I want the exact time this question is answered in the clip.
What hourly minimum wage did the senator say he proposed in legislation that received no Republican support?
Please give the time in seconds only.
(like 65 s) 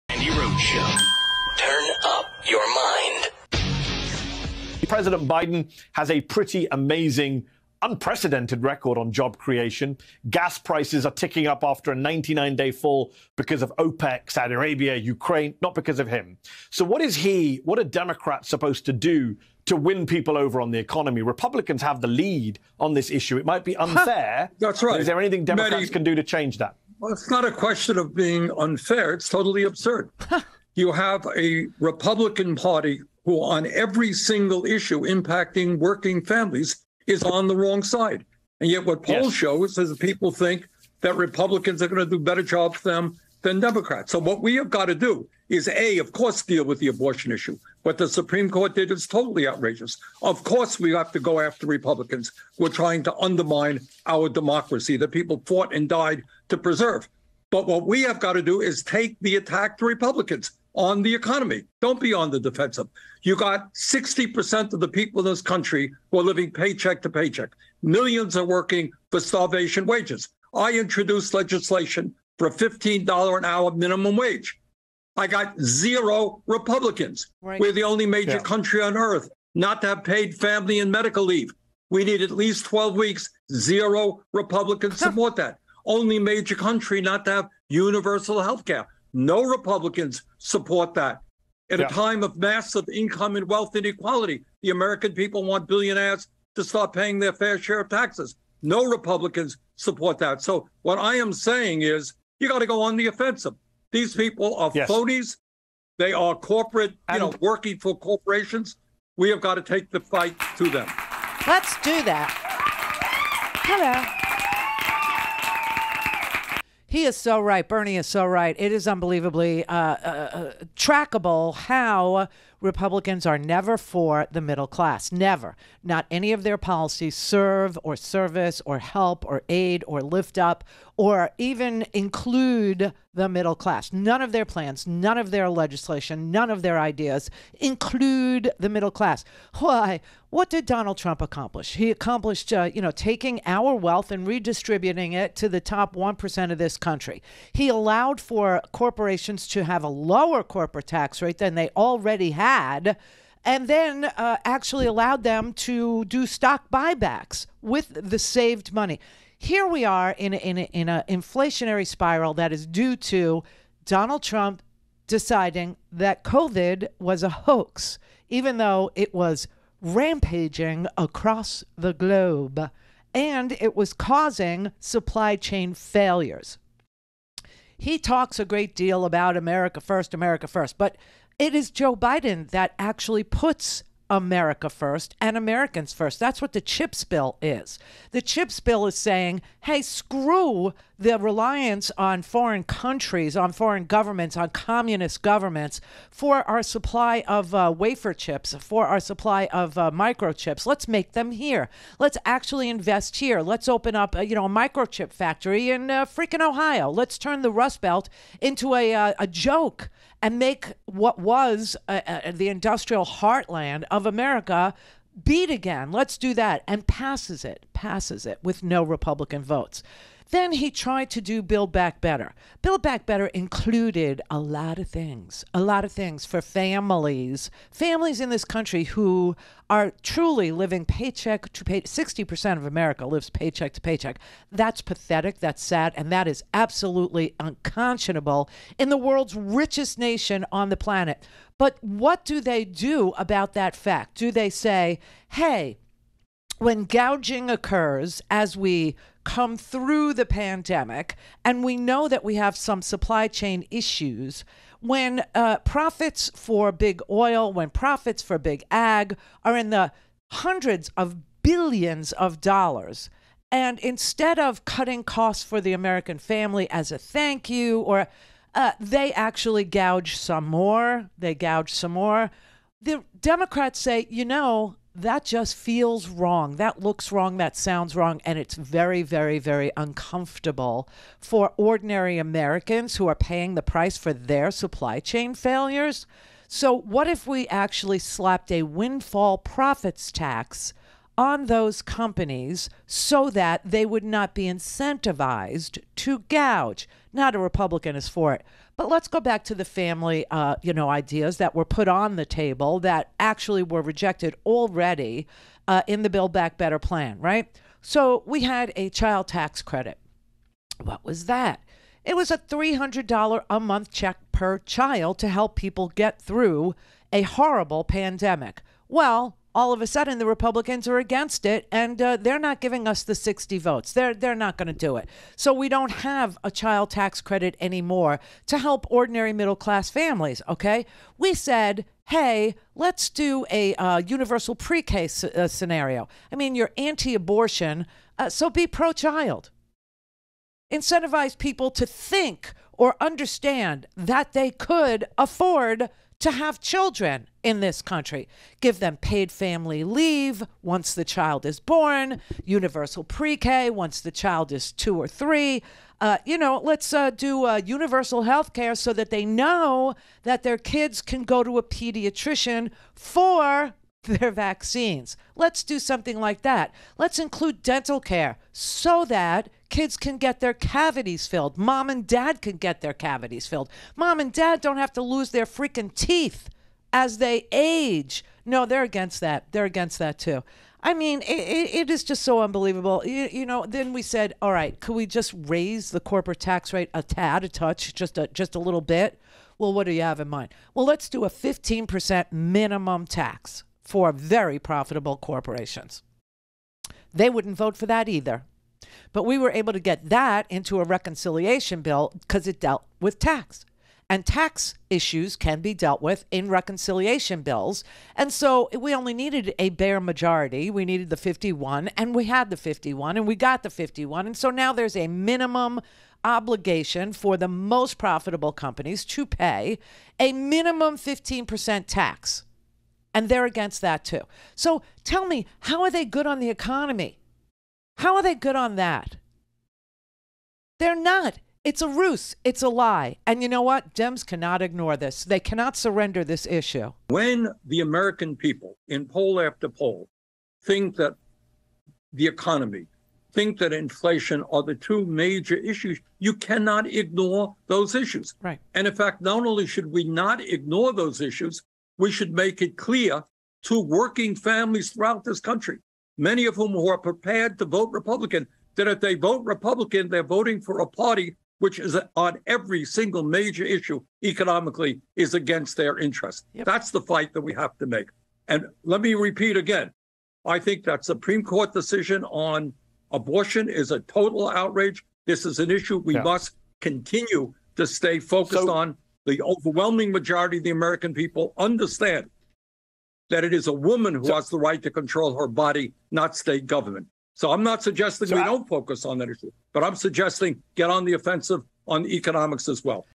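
72 s.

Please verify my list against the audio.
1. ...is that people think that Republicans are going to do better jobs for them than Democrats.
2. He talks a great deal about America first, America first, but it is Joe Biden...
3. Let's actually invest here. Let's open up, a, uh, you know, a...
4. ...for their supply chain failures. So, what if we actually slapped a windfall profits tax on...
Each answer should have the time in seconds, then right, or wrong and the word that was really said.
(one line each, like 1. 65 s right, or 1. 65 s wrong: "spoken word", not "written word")
1. 39 s right
2. 177 s right
3. 201 s right
4. 283 s right.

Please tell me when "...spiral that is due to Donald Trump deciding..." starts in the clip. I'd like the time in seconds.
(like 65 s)
161 s.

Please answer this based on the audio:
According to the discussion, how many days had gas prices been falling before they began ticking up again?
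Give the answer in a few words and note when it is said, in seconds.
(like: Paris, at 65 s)
99, at 11 s.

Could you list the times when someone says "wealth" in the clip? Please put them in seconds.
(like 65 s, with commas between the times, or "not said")
93 s, 143 s.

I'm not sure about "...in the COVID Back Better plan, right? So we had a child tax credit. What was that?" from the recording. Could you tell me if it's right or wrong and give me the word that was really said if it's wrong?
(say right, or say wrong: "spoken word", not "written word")
wrong: "Build", not "COVID".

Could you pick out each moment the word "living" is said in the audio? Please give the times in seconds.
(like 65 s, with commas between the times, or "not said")
66 s, 230 s.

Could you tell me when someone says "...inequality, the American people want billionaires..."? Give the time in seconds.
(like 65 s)
93 s.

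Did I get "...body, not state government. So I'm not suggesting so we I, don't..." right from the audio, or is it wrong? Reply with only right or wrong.
right.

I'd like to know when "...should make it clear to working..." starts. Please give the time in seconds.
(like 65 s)
452 s.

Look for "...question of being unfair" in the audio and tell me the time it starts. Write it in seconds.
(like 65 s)
27 s.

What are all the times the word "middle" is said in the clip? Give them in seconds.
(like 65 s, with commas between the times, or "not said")
124 s, 133 s, 138 s, 329 s.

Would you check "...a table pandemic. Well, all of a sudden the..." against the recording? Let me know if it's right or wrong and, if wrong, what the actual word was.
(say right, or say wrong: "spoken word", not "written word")
wrong: "horrible", not "table".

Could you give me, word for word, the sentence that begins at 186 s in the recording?
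That's what the CHIPS bill is.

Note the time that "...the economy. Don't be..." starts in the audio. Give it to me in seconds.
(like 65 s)
61 s.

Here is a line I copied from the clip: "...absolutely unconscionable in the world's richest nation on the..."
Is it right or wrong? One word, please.
right.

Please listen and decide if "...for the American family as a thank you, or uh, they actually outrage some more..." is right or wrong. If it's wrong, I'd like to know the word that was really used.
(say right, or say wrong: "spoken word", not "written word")
wrong: "gouge", not "outrage".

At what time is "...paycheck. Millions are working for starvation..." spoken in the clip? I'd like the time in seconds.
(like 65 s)
67 s.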